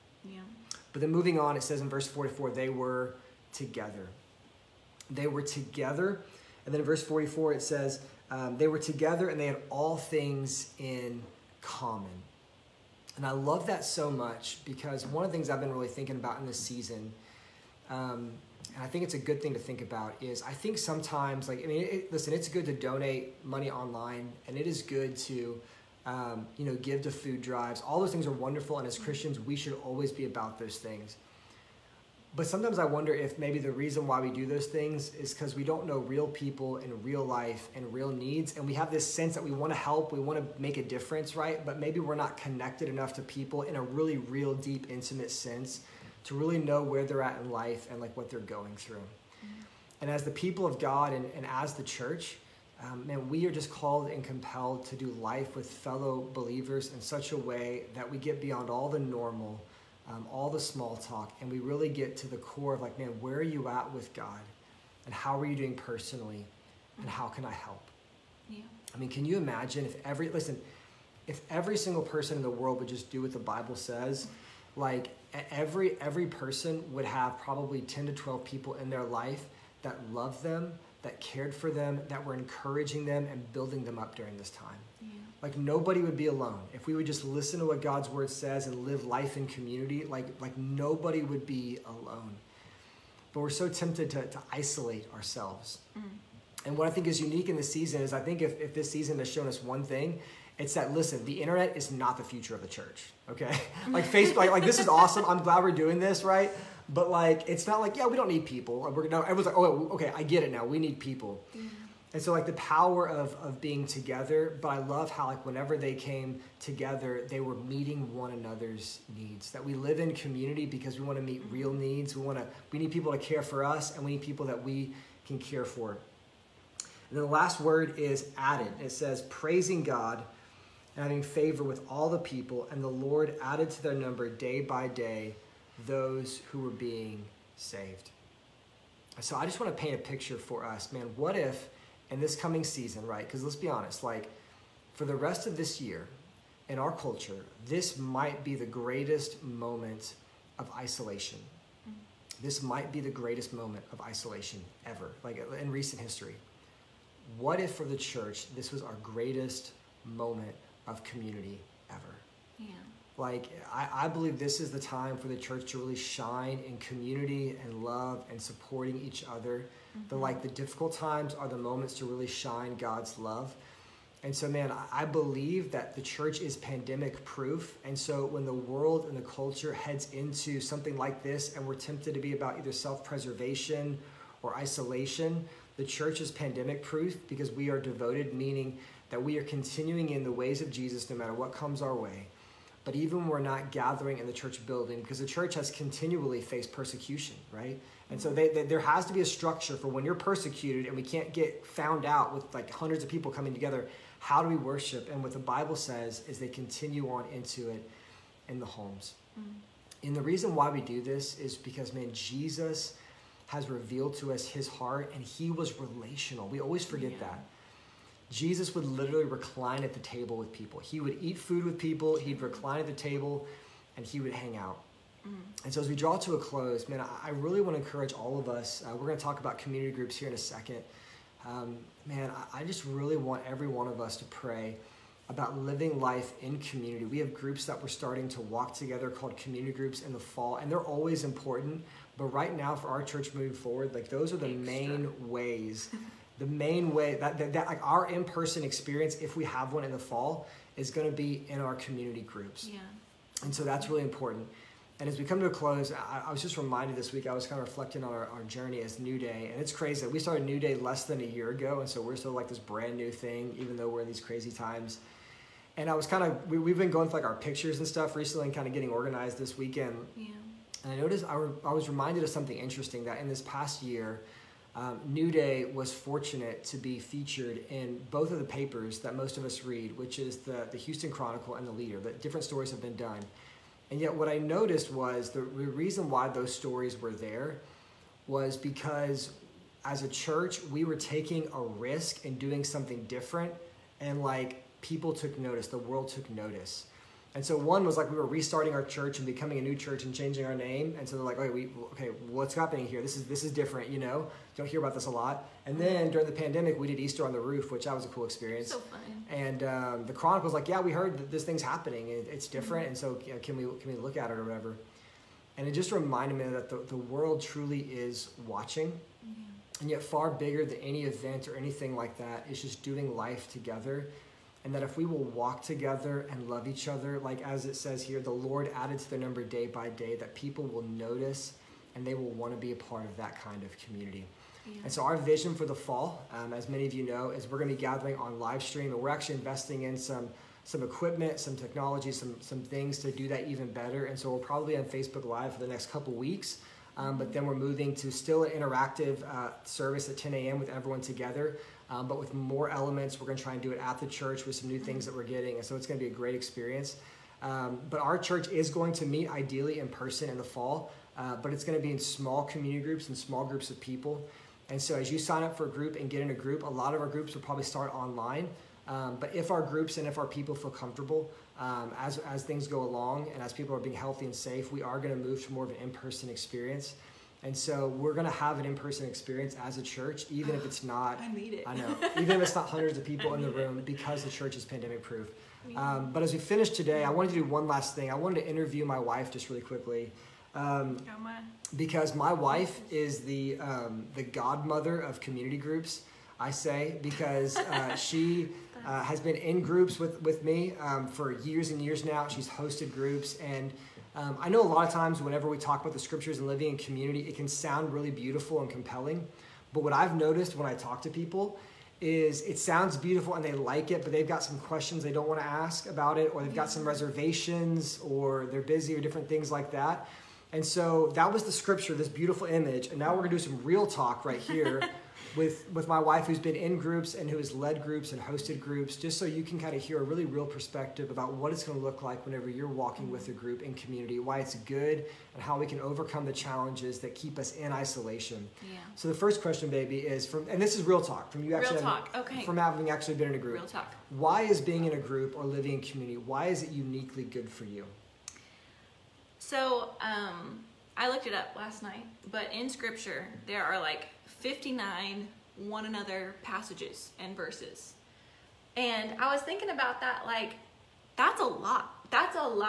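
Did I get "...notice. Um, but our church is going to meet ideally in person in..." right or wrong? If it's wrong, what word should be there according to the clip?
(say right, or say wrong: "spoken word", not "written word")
wrong: "experience", not "notice".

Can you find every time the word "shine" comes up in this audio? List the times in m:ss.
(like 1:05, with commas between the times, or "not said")
2:45, 2:52.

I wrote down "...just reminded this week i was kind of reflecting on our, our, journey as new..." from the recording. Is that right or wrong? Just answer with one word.
right.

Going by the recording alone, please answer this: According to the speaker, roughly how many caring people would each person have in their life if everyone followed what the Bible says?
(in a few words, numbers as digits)
10 to 12.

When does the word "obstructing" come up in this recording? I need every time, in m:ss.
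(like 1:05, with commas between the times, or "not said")
not said.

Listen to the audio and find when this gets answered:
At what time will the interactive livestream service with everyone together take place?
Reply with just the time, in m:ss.
5:50.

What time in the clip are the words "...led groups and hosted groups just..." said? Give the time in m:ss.
7:07.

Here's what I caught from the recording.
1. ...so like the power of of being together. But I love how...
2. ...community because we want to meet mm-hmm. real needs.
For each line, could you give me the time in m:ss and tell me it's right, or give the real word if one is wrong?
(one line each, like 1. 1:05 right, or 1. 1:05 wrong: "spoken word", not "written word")
1. 1:52 right
2. 2:00 right.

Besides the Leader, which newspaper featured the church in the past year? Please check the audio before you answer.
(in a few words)
Houston Chronicle.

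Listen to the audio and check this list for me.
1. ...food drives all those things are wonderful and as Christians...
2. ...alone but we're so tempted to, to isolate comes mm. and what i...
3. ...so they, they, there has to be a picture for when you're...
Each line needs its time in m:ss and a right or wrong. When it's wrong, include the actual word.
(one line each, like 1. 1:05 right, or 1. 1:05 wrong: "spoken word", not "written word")
1. 0:27 right
2. 1:31 wrong: "ourselves", not "comes"
3. 3:18 wrong: "structure", not "picture".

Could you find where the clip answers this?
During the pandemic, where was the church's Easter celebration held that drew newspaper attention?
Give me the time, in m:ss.
5:07.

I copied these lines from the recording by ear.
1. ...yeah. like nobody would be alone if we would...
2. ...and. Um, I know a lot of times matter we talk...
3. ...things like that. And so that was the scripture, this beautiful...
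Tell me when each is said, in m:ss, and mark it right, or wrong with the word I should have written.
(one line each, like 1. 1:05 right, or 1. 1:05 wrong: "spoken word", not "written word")
1. 1:25 right
2. 6:43 wrong: "whenever", not "matter"
3. 6:59 right.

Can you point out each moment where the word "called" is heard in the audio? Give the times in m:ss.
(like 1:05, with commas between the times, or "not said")
0:53, 3:59.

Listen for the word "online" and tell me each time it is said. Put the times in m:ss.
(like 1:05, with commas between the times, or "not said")
0:23, 6:07.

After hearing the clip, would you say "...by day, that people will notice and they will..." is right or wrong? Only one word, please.
right.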